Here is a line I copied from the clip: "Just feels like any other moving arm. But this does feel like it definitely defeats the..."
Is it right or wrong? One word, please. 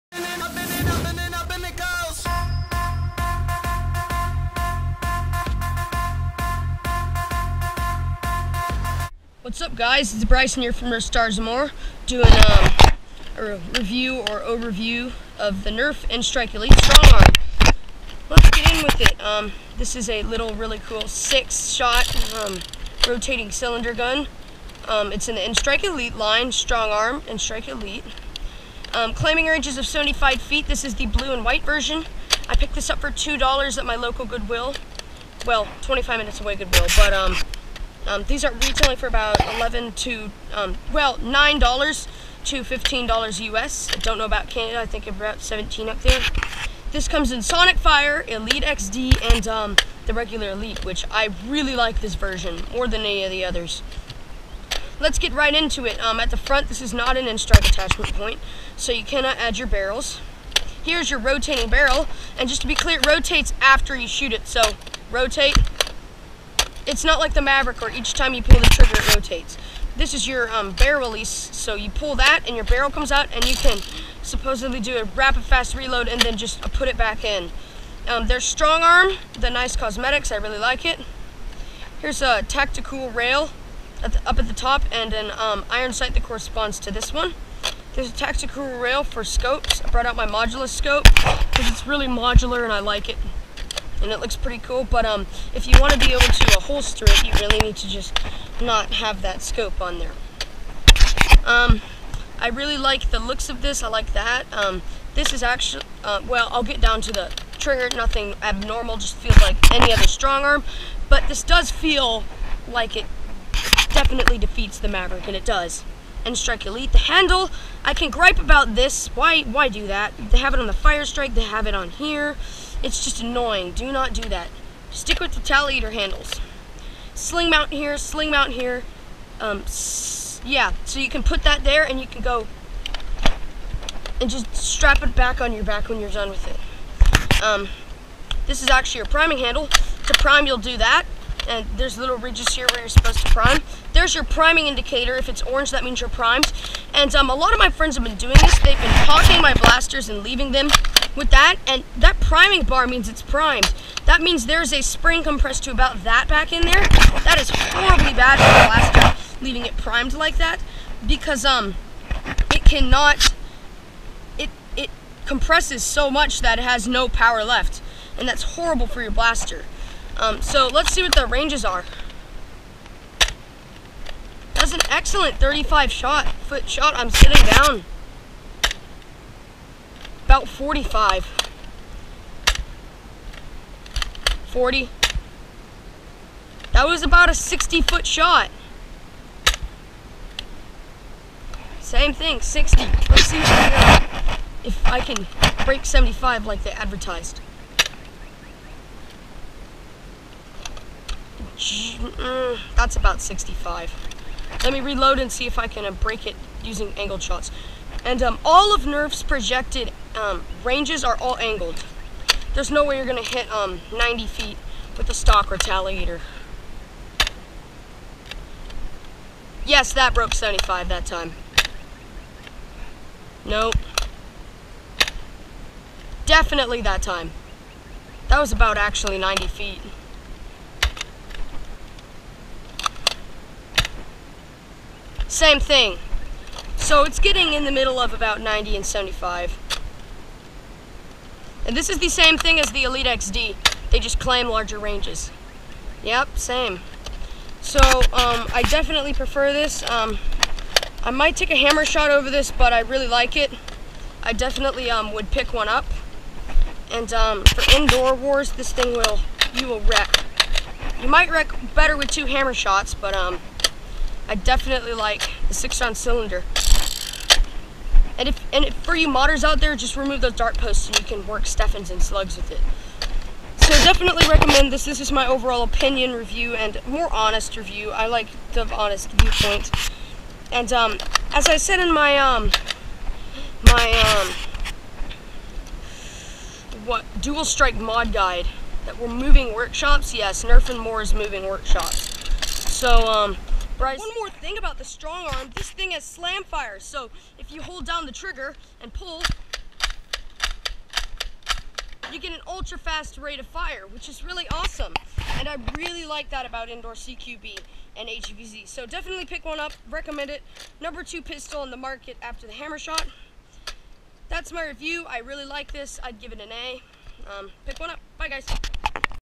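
wrong.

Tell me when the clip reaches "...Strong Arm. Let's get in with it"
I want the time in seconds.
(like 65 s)
16 s.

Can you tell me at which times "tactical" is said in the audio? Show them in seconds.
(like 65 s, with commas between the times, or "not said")
82 s, 88 s.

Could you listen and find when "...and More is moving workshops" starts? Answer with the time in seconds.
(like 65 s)
290 s.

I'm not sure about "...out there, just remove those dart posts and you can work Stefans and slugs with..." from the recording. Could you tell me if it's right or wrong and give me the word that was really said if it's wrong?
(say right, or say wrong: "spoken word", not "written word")
right.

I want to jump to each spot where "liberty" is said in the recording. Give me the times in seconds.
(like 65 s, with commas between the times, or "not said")
not said.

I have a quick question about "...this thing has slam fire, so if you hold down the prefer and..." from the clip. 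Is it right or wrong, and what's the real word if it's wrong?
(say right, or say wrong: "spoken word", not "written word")
wrong: "trigger", not "prefer".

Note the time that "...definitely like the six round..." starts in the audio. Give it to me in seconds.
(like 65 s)
264 s.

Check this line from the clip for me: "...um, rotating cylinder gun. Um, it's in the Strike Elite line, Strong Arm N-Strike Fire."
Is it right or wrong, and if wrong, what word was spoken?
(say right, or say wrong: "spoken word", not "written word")
wrong: "Elite", not "Fire".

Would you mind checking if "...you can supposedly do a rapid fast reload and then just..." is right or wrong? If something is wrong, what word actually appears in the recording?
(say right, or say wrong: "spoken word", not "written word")
right.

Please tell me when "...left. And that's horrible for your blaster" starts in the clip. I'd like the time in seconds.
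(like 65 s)
167 s.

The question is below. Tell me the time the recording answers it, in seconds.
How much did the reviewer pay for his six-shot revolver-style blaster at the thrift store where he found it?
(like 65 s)
33 s.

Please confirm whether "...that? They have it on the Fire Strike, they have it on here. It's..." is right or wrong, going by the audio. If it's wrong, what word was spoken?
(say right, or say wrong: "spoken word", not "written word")
right.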